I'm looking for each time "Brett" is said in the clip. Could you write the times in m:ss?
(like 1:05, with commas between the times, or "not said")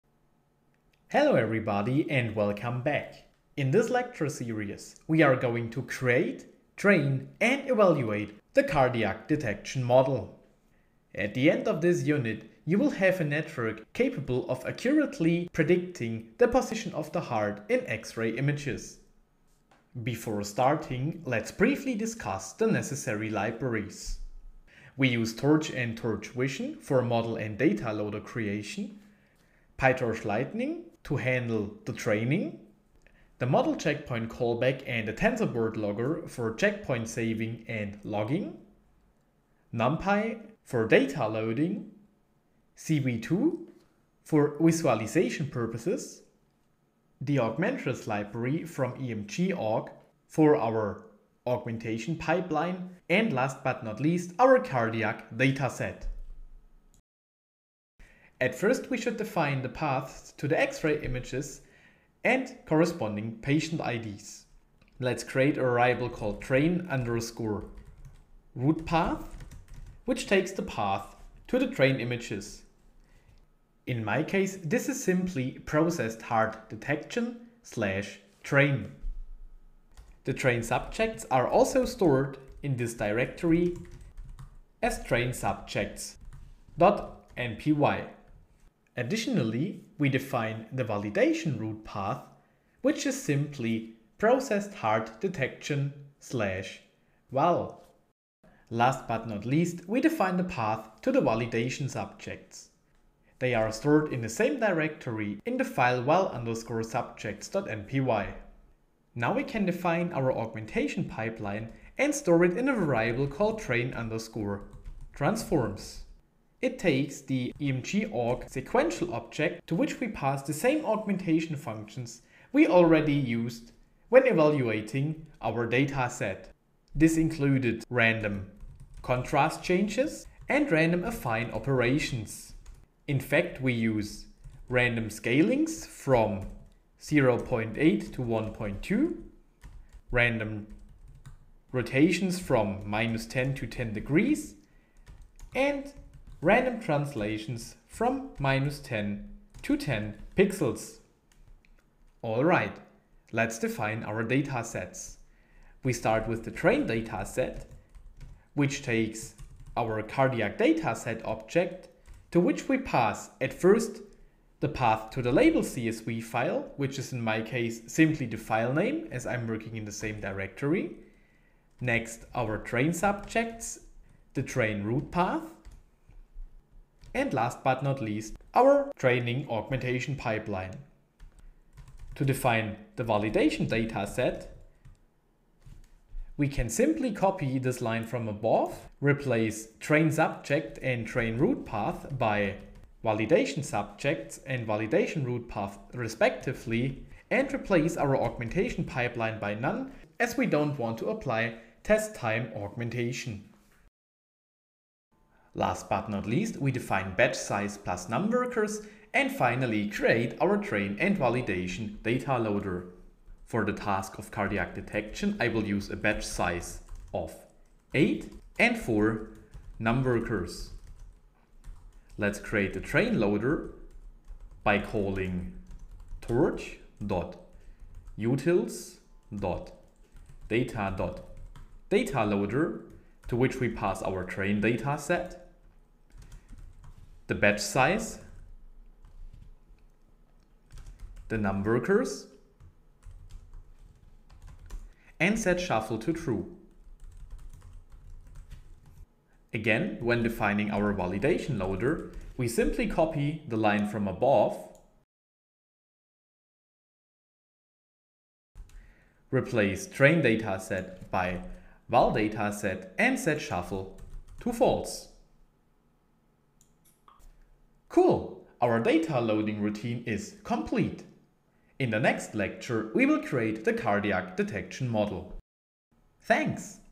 not said.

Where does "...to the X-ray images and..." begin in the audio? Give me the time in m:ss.
1:00.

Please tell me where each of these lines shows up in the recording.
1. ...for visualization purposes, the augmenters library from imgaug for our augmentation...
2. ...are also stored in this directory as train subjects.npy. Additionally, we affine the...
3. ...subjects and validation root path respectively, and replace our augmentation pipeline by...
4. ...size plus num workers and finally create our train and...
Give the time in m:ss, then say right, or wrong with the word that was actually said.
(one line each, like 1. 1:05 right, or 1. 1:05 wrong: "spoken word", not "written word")
1. 0:44 right
2. 1:21 wrong: "define", not "affine"
3. 3:13 right
4. 3:27 right.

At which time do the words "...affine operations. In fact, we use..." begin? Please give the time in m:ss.
2:11.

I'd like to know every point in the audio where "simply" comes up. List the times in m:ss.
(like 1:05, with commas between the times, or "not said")
1:15, 1:33, 2:47, 3:06, 4:12.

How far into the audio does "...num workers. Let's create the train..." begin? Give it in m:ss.
3:39.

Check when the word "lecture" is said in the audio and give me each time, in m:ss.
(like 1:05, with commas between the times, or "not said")
0:03, 4:32.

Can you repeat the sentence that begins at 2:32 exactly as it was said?
Alright, let's define our data sets.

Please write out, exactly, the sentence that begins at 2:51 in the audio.
Next, our train subjects, the train root path, and last but not least, our training augmentation pipeline.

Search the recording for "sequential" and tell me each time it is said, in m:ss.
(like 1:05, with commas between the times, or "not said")
1:58.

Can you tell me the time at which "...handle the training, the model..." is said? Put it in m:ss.
0:31.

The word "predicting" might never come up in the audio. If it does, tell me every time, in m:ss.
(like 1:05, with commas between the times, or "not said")
0:15.